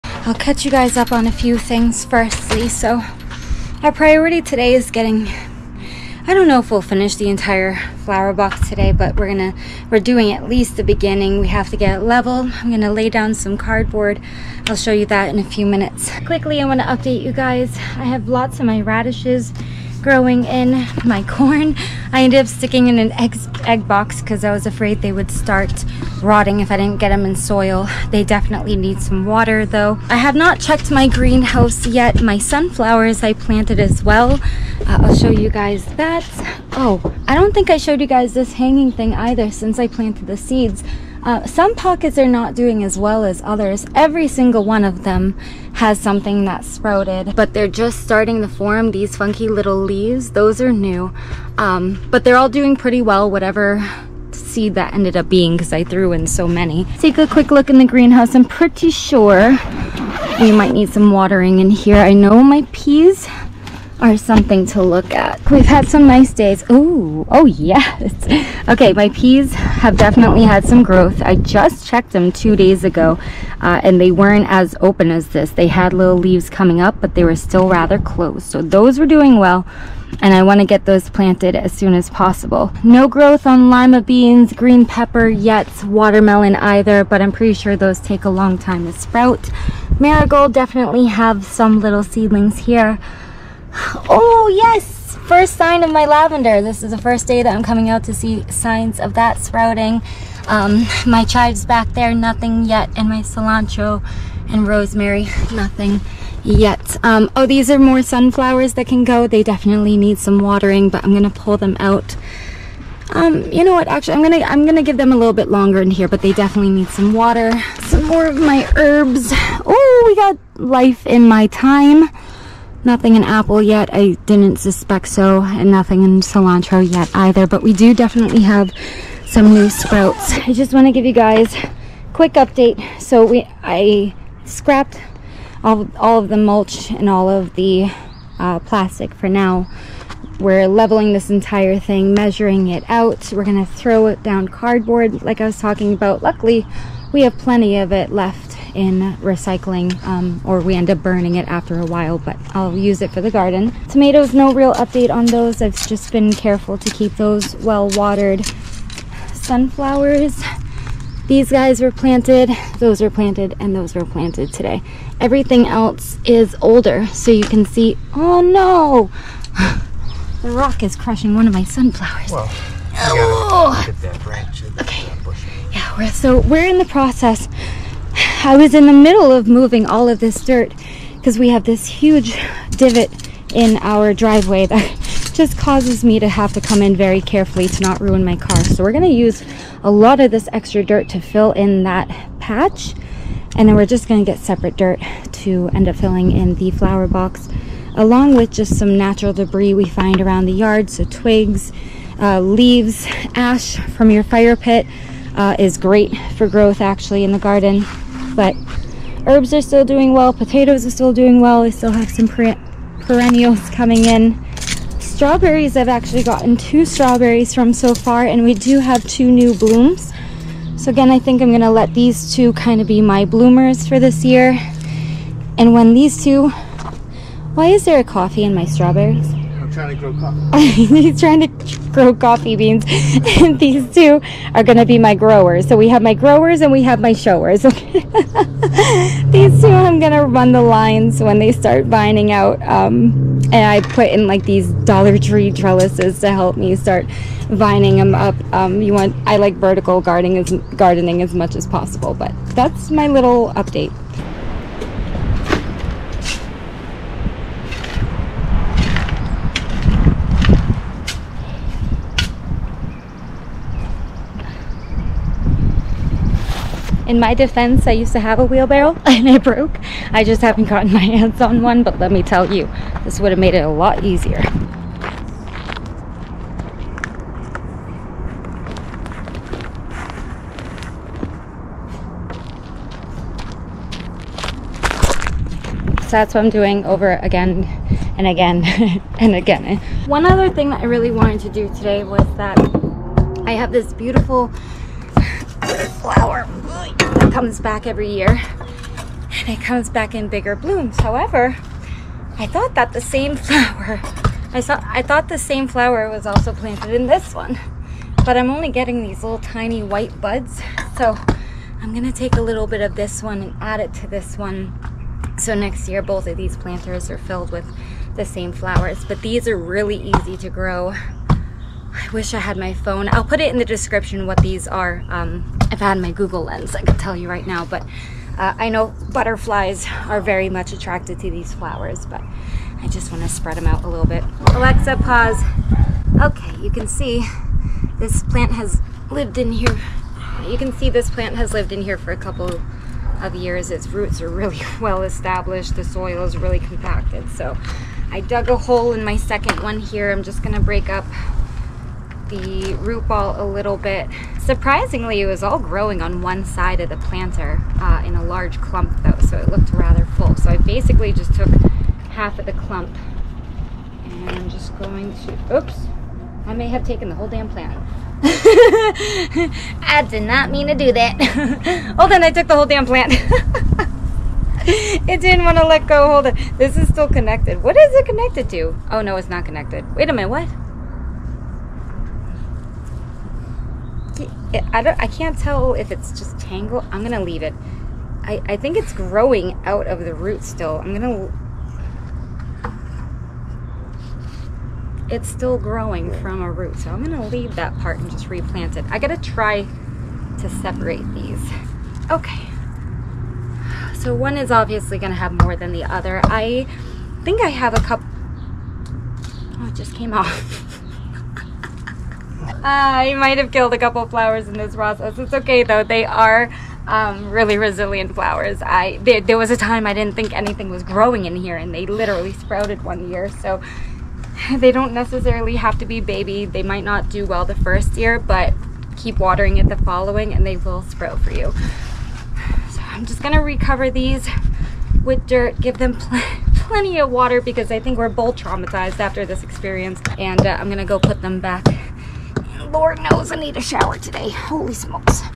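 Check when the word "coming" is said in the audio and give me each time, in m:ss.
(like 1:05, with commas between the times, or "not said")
1:16, 1:37, 3:33.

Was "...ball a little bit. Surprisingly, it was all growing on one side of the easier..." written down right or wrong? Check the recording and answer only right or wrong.
wrong.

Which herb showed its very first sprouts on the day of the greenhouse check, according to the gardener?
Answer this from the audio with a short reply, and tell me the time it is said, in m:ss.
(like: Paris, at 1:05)
Lavender, at 1:36.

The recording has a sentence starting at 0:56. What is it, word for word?
Take a quick look in the greenhouse.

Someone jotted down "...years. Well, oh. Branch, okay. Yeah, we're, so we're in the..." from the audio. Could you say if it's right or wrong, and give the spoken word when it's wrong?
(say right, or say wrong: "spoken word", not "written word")
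wrong: "sunflowers", not "years".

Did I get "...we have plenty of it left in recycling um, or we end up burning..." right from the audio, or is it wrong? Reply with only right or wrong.
right.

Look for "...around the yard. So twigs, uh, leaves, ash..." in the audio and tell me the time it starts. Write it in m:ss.
3:20.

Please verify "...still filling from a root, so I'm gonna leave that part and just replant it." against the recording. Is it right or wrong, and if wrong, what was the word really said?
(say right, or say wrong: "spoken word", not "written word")
wrong: "growing", not "filling".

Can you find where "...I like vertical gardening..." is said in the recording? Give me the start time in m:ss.
4:09.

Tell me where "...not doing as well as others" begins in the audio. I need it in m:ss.
0:42.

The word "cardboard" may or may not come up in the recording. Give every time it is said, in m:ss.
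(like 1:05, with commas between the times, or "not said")
0:13, 2:24.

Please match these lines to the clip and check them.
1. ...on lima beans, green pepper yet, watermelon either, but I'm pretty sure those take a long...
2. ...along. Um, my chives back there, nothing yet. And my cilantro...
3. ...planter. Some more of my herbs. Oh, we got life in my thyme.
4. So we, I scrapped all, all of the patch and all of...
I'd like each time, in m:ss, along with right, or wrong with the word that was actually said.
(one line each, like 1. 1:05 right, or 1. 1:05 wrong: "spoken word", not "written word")
1. 1:23 right
2. 1:39 wrong: "sprouting", not "along"
3. 1:57 wrong: "water", not "planter"
4. 2:12 wrong: "mulch", not "patch".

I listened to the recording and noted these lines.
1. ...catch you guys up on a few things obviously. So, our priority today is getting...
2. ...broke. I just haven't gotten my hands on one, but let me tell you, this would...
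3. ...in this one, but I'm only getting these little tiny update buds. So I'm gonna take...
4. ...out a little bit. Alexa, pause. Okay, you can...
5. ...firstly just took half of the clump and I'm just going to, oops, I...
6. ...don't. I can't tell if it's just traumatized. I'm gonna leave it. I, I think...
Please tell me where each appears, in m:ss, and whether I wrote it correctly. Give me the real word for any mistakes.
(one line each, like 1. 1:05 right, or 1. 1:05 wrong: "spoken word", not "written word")
1. 0:00 wrong: "firstly", not "obviously"
2. 4:29 right
3. 5:06 wrong: "white", not "update"
4. 5:33 right
5. 6:00 wrong: "basically", not "firstly"
6. 6:24 wrong: "tangled", not "traumatized".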